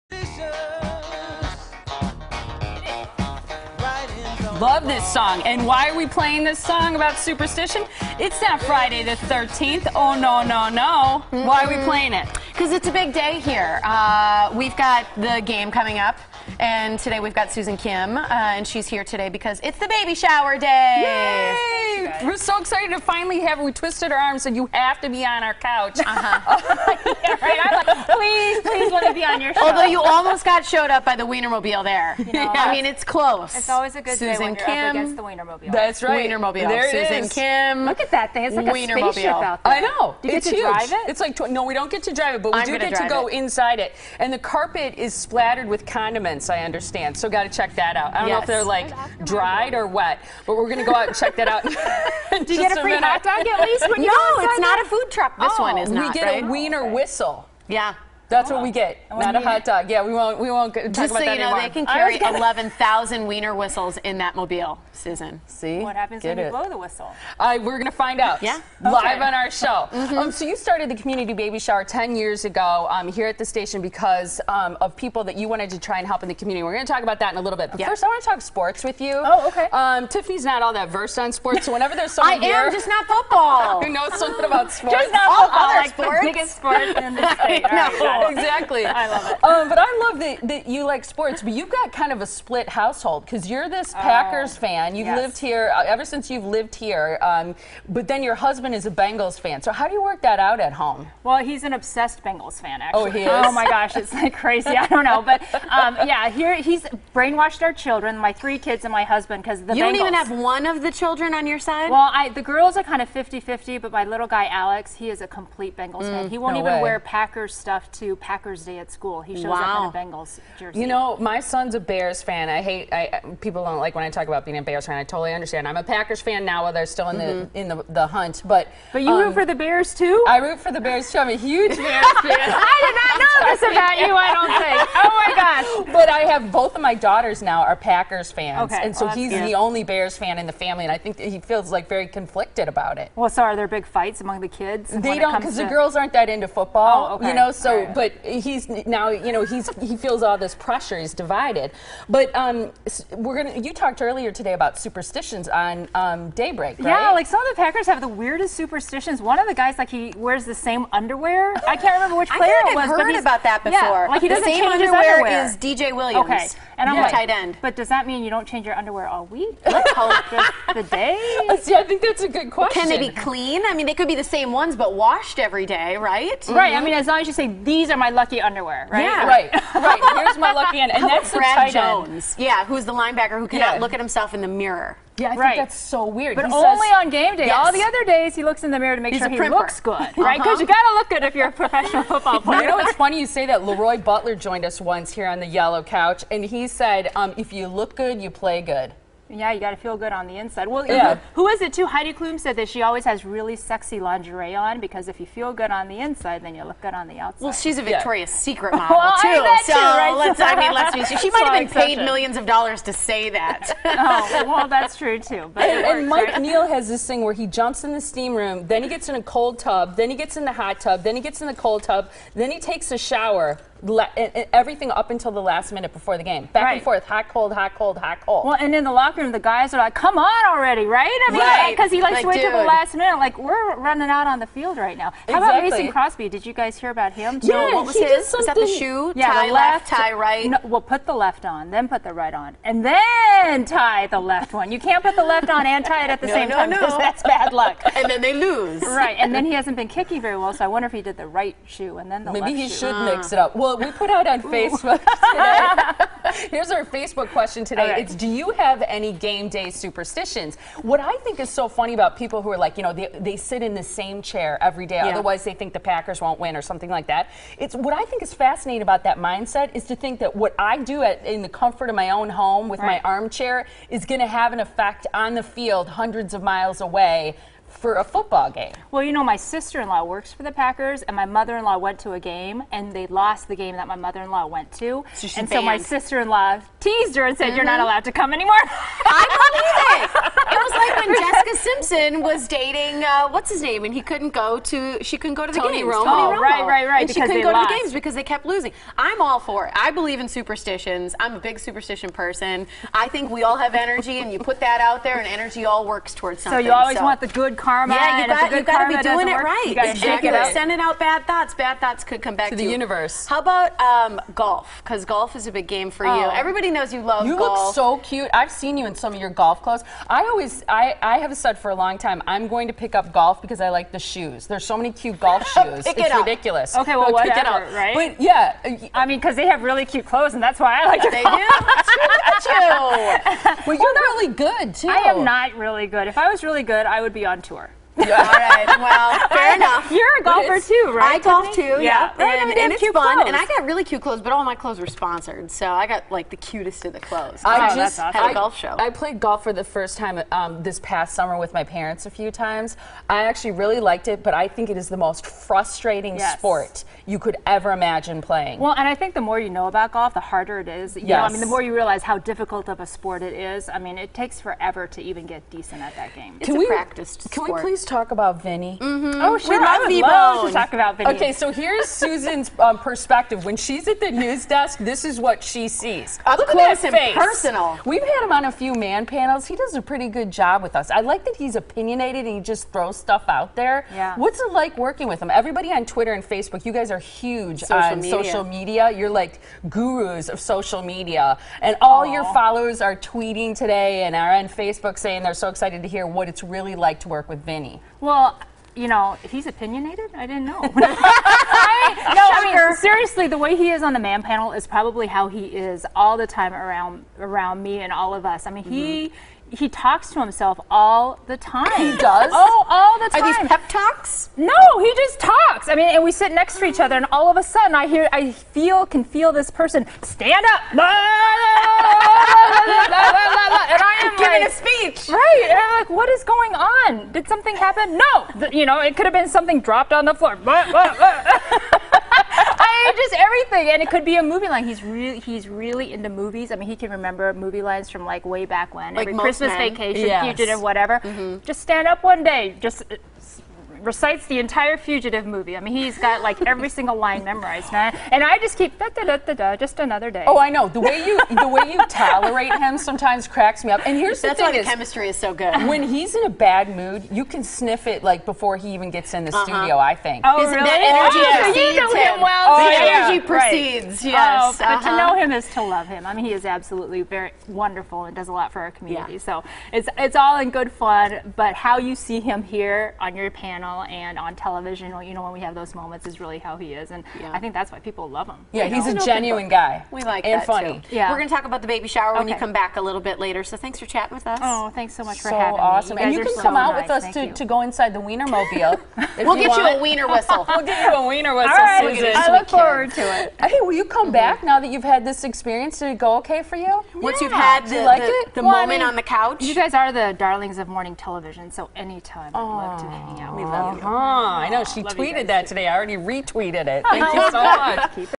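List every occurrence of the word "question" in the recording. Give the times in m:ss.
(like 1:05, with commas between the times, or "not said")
2:52, 4:17.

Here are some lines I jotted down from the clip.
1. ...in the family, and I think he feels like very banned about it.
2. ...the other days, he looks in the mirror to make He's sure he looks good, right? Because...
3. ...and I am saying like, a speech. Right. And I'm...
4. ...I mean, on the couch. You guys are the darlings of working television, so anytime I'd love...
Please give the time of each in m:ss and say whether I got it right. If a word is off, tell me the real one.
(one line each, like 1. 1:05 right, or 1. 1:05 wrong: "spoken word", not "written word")
1. 2:20 wrong: "conflicted", not "banned"
2. 3:07 right
3. 7:00 wrong: "giving", not "saying"
4. 8:18 wrong: "morning", not "working".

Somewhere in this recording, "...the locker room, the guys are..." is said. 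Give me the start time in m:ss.
3:48.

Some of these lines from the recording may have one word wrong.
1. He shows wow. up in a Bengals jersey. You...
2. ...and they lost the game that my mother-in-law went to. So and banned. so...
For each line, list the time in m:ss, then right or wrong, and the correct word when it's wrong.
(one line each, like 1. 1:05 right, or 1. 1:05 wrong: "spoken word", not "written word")
1. 1:59 right
2. 4:42 right.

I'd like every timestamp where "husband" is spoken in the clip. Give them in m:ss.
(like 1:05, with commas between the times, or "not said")
1:38, 1:49.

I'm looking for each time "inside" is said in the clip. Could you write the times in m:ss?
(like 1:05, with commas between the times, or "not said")
0:43, 3:20, 3:25, 8:07.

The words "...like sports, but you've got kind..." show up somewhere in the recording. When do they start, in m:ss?
1:30.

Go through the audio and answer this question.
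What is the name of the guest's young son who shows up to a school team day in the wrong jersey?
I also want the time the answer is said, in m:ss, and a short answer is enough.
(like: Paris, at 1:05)
Alex, at 1:54.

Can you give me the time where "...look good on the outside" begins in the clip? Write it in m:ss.
3:26.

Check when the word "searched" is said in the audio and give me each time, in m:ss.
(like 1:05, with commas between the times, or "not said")
not said.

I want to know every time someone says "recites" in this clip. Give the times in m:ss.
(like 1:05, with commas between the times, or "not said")
7:23.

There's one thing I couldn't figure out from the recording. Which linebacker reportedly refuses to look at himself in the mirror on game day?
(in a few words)
Brad Jones.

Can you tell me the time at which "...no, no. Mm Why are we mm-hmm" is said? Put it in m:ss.
0:10.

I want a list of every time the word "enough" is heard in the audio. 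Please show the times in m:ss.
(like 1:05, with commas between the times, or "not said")
5:39.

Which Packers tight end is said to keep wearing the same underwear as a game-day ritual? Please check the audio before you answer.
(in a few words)
DJ Williams.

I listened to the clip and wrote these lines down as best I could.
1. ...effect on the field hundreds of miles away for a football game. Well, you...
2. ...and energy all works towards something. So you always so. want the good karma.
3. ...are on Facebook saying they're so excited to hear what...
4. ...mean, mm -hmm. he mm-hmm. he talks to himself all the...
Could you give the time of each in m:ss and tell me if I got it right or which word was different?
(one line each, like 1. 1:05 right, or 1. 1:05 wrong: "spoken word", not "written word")
1. 4:34 right
2. 5:05 right
3. 6:34 right
4. 6:48 right.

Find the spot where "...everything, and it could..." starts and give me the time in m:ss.
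7:13.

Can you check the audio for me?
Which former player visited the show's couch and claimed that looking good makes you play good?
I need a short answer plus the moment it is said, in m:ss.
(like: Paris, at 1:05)
Leroy Butler, at 3:13.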